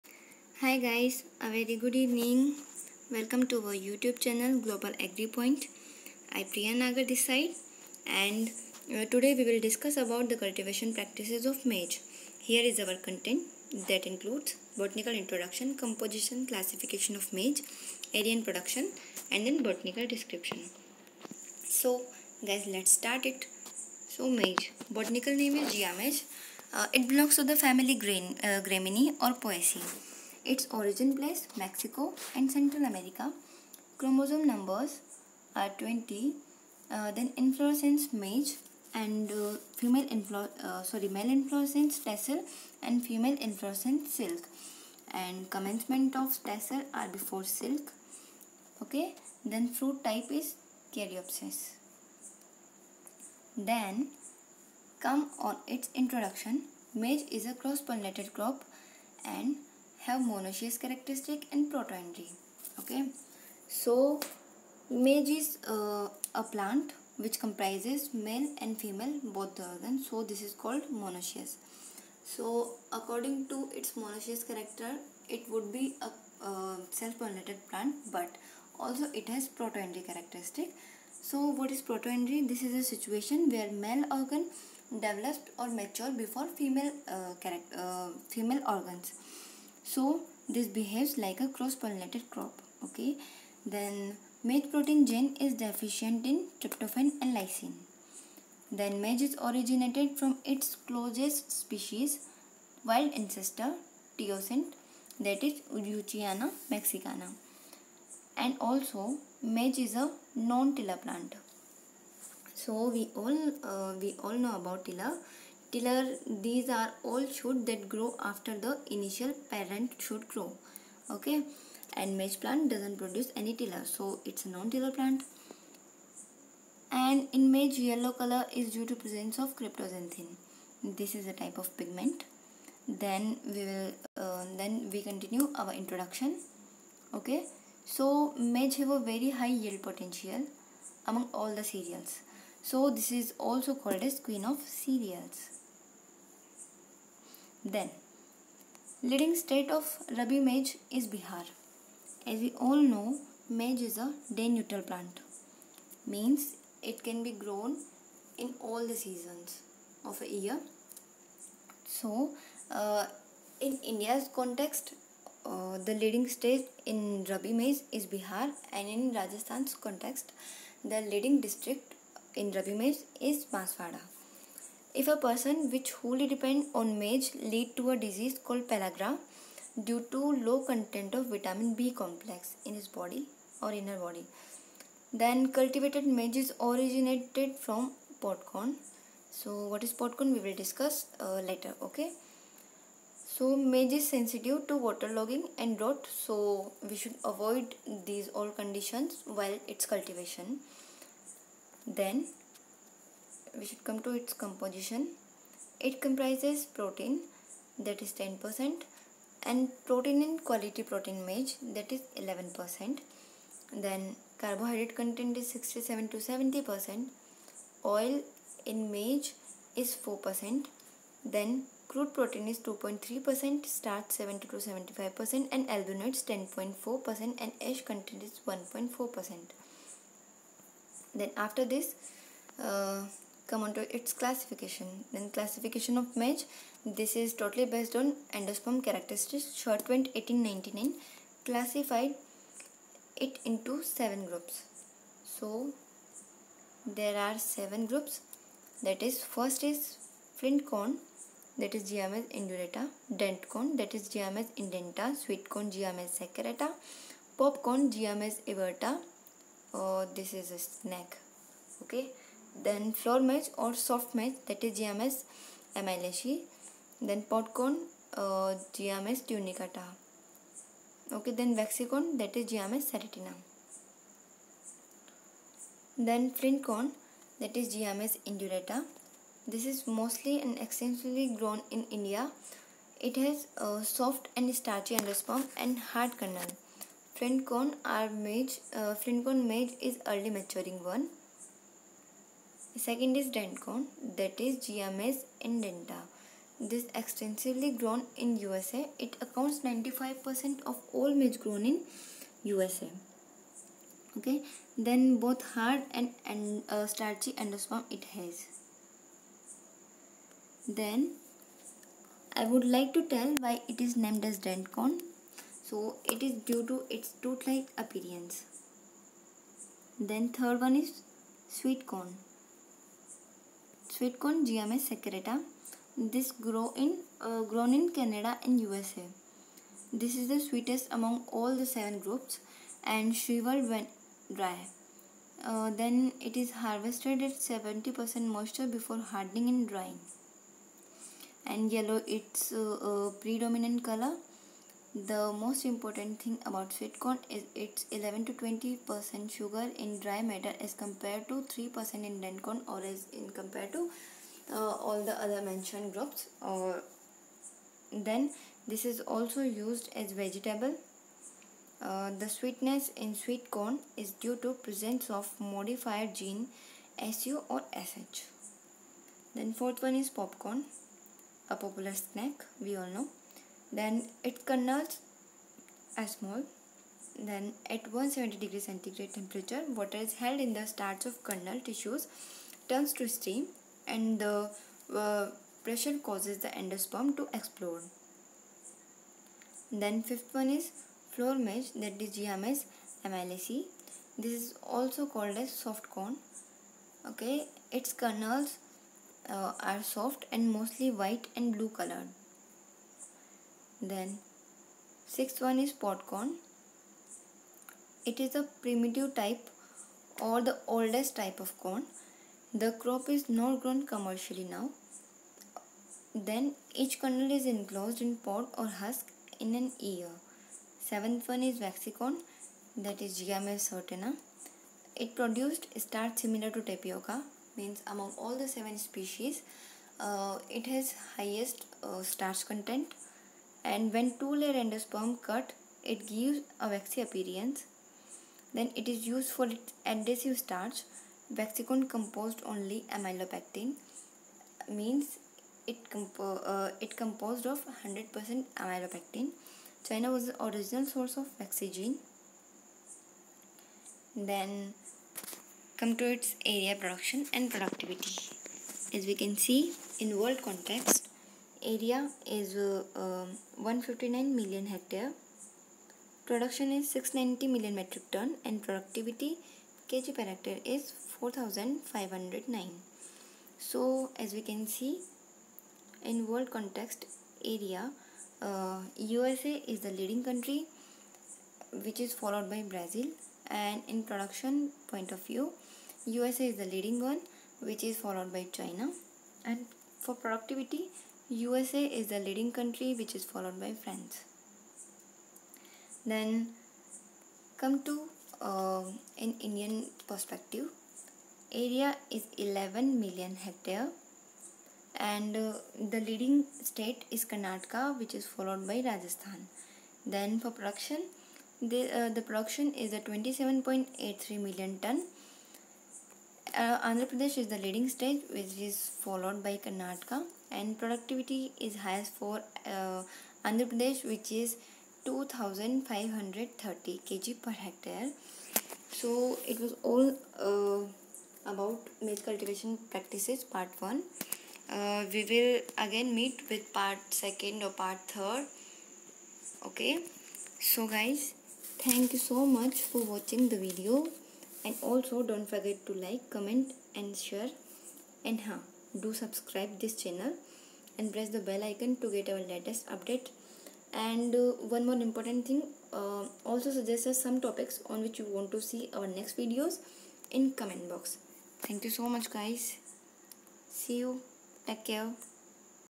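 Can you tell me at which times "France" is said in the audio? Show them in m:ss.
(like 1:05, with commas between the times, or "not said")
8:13.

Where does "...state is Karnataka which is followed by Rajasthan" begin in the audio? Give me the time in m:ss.
8:26.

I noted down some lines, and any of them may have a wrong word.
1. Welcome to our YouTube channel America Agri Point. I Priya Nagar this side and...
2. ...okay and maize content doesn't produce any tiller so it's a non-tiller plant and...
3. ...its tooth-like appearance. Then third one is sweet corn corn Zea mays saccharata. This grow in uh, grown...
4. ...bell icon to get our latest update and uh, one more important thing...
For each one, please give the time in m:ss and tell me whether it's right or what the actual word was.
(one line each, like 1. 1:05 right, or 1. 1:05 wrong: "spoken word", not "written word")
1. 0:03 wrong: "Global", not "America"
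2. 2:01 wrong: "plant", not "content"
3. 5:16 right
4. 9:11 right.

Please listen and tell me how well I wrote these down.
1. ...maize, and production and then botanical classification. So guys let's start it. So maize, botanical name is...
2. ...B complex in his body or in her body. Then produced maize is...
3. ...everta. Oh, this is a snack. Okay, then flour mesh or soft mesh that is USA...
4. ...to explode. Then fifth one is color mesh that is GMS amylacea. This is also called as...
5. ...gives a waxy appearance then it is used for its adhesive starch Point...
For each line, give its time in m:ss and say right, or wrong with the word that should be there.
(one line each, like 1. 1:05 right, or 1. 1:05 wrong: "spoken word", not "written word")
1. 0:17 wrong: "description", not "classification"
2. 3:01 wrong: "cultivated", not "produced"
3. 4:18 wrong: "GMS", not "USA"
4. 6:27 wrong: "floor", not "color"
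5. 7:16 wrong: "Waxy", not "Point".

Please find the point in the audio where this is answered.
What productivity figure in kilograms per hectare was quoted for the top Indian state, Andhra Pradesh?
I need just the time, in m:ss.
8:45.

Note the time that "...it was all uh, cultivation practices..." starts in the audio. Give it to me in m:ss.
8:49.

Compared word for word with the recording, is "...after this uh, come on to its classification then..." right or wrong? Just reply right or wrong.
right.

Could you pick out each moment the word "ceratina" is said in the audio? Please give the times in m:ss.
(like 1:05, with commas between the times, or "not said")
4:32, 7:03.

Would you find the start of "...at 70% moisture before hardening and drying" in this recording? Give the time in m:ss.
5:37.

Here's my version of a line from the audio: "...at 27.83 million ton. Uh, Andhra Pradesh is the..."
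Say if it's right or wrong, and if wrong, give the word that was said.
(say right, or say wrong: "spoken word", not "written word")
right.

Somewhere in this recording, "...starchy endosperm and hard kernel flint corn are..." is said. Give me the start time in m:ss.
4:44.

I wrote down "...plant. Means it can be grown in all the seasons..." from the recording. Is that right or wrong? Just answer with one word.
right.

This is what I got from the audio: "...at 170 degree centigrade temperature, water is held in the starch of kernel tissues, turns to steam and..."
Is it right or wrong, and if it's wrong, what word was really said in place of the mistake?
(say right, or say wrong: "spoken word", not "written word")
right.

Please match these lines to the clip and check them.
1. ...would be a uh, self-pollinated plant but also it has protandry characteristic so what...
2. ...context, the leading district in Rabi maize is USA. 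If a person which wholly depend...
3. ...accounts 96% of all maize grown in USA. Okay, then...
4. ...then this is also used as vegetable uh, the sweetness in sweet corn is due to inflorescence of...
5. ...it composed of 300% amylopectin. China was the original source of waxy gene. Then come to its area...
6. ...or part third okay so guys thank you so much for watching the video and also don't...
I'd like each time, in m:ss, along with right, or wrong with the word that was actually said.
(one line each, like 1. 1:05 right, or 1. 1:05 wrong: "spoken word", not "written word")
1. 1:15 right
2. 2:49 wrong: "Banswara", not "USA"
3. 4:59 wrong: "95", not "96"
4. 5:57 wrong: "presence", not "inflorescence"
5. 7:26 wrong: "100", not "300"
6. 8:57 right.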